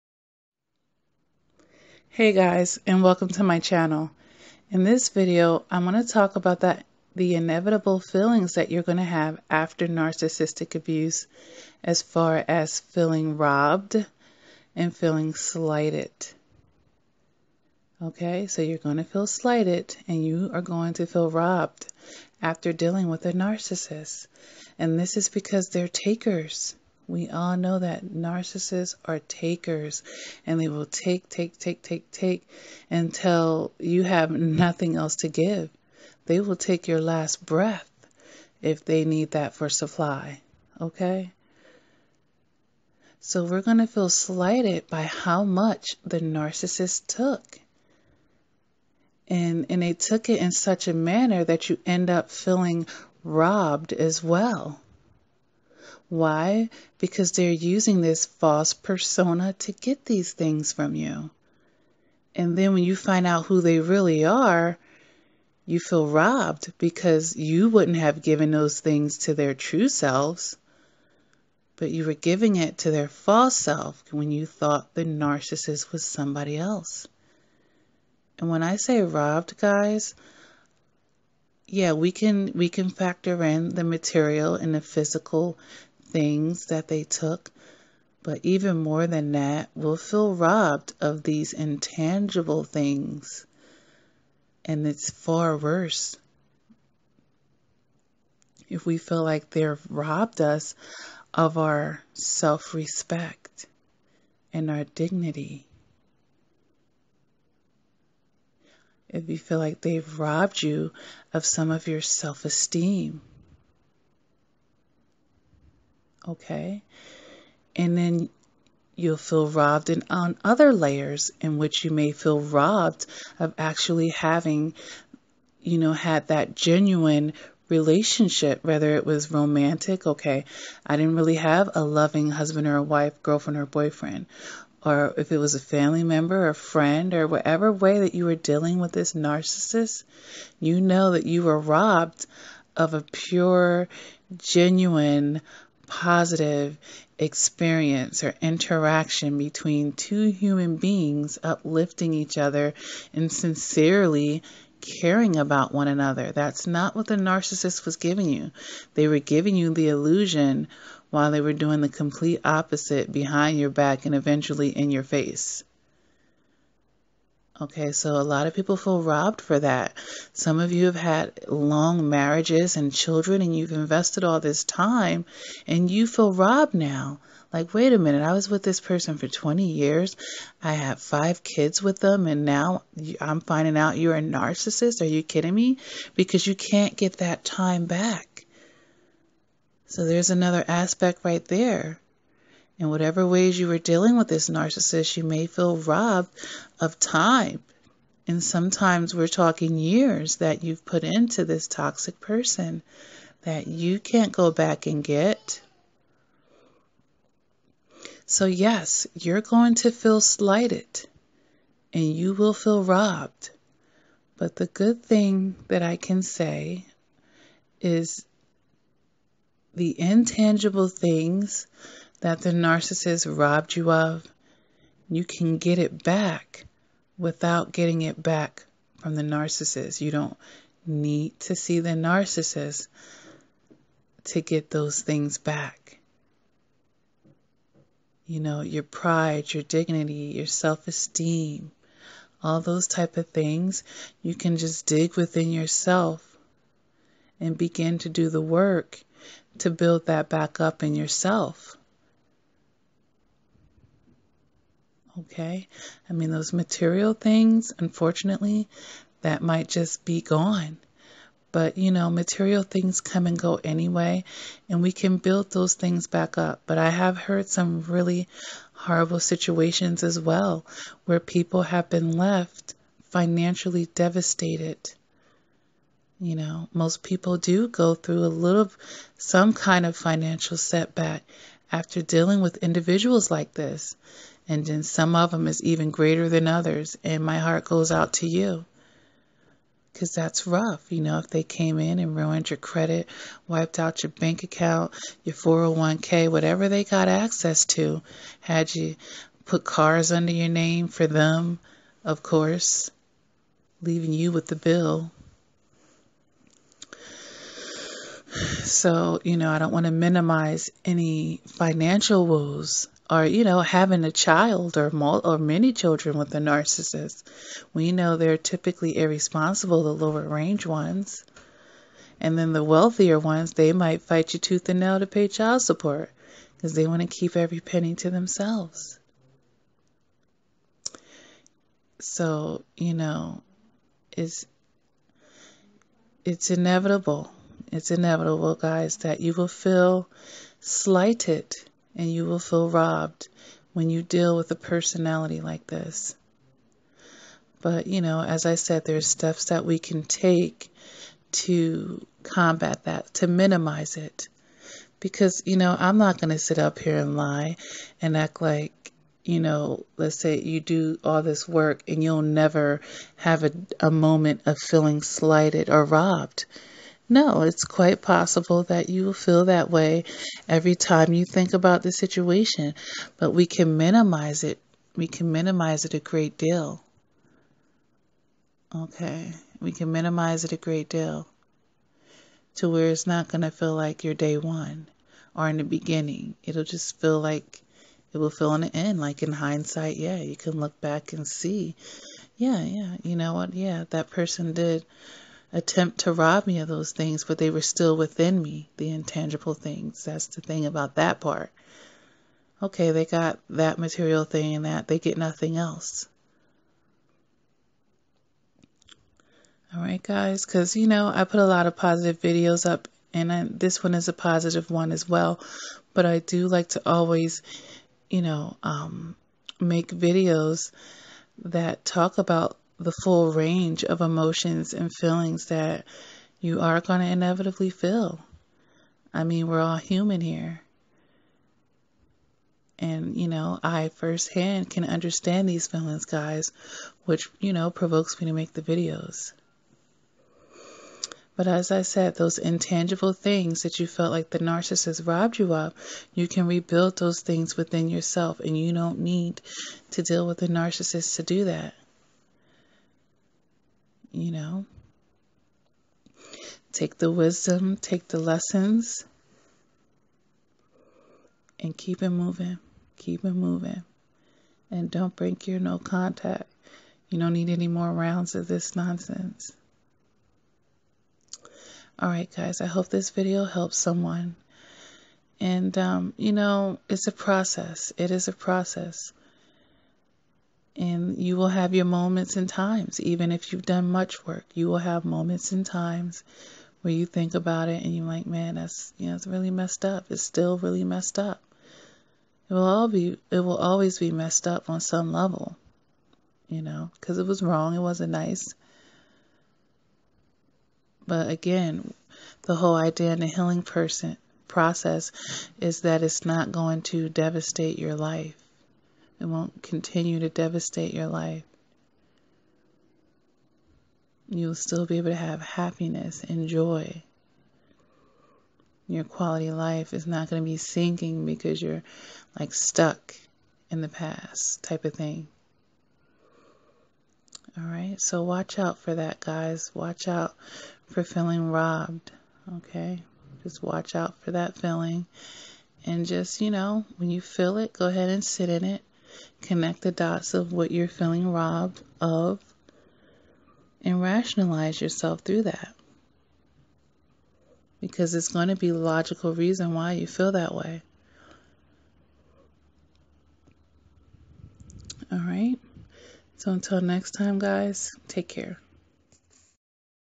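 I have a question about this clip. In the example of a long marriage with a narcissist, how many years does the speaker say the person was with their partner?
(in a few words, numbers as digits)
20.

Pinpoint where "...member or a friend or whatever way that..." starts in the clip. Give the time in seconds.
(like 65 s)
136 s.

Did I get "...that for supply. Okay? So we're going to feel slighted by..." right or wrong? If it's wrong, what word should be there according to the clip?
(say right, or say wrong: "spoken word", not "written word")
right.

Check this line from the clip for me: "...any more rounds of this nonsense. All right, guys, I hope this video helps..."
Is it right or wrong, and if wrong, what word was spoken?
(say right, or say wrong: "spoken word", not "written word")
right.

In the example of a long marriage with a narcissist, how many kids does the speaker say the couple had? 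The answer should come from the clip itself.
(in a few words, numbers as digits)
5.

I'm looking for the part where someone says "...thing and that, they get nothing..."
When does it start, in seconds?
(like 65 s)
404 s.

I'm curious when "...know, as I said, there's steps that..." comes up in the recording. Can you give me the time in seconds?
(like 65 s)
348 s.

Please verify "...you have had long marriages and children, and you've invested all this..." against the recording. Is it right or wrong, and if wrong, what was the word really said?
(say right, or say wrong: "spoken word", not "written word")
right.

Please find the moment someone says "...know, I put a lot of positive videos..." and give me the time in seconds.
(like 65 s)
410 s.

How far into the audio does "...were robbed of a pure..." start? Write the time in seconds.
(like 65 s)
141 s.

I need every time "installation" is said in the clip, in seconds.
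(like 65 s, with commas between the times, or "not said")
not said.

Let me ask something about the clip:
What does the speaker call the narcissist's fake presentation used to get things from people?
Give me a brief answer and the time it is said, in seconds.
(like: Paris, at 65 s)
False persona, at 58 s.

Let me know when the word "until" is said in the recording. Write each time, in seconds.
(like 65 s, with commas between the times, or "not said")
32 s, 556 s.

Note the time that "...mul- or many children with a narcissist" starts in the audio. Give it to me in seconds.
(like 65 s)
314 s.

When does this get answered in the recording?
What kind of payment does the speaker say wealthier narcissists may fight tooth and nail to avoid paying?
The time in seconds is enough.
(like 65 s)
325 s.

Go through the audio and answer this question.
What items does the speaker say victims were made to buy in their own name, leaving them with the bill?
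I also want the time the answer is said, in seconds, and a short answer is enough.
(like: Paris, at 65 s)
Cars, at 299 s.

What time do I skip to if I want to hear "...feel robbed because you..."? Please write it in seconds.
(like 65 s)
65 s.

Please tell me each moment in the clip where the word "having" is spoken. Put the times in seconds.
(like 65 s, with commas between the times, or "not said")
124 s, 313 s.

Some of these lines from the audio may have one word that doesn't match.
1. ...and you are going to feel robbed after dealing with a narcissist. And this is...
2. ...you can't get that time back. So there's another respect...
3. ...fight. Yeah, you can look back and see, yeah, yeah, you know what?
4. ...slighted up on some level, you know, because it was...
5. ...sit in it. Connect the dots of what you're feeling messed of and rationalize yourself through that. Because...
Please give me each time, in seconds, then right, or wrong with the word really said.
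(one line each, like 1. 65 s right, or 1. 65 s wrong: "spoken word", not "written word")
1. 20 s right
2. 186 s wrong: "aspect", not "respect"
3. 389 s wrong: "hindsight", not "fight"
4. 494 s wrong: "messed", not "slighted"
5. 538 s wrong: "robbed", not "messed".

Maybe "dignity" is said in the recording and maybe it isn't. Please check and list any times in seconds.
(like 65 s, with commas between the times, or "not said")
104 s, 239 s.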